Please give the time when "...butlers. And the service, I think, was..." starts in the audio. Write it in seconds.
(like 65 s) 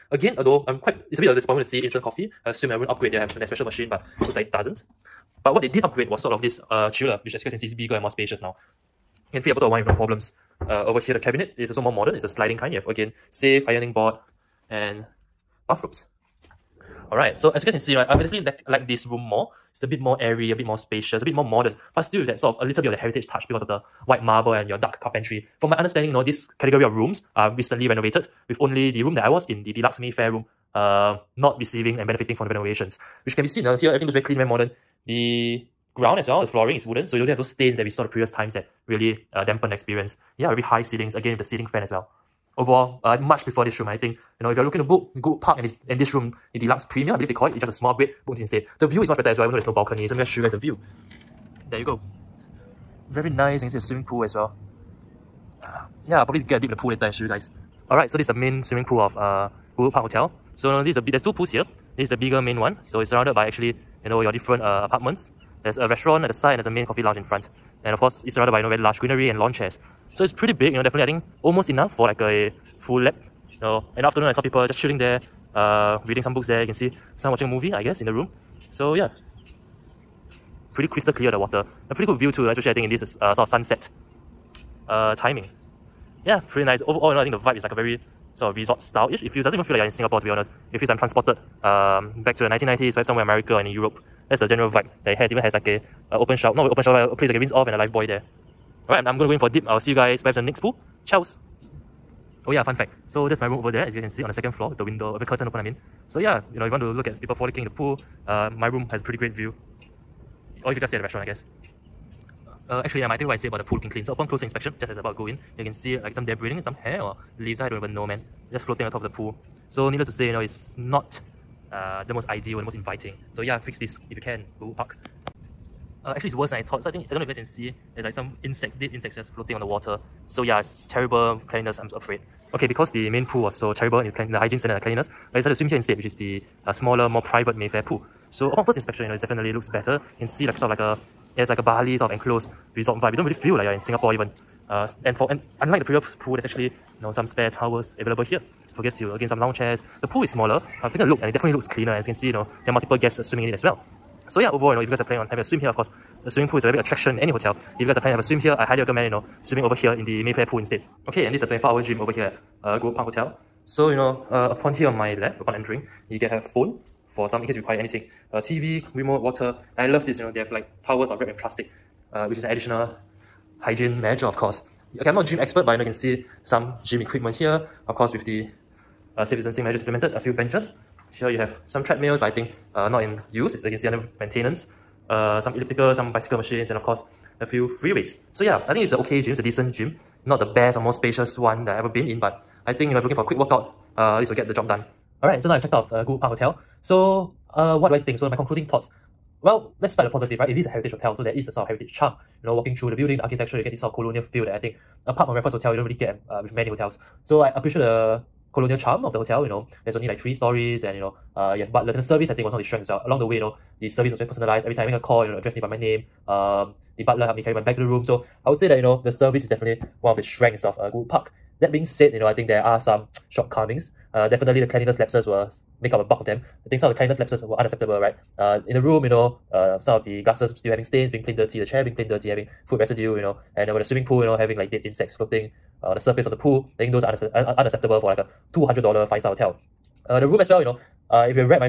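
211 s.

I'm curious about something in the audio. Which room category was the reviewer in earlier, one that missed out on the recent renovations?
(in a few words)
Deluxe Mayfair.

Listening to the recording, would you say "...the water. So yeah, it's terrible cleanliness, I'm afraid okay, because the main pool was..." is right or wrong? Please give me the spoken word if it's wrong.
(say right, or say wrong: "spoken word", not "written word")
right.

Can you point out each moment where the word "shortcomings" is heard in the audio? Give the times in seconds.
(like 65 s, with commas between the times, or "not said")
223 s.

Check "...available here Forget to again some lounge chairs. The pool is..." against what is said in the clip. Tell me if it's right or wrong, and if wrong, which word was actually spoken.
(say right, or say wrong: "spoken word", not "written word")
right.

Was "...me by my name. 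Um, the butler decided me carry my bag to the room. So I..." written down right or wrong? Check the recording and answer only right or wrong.
wrong.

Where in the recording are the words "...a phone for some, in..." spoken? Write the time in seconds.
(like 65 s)
166 s.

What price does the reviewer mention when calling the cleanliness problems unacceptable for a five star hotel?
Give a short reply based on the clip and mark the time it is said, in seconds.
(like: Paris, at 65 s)
$200, at 238 s.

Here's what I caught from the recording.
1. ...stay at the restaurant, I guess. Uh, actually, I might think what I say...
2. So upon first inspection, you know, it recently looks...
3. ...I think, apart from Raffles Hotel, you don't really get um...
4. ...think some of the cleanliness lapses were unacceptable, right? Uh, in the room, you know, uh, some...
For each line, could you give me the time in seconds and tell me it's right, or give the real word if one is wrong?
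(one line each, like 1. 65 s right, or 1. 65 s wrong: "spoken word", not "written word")
1. 110 s right
2. 138 s wrong: "definitely", not "recently"
3. 204 s right
4. 226 s right.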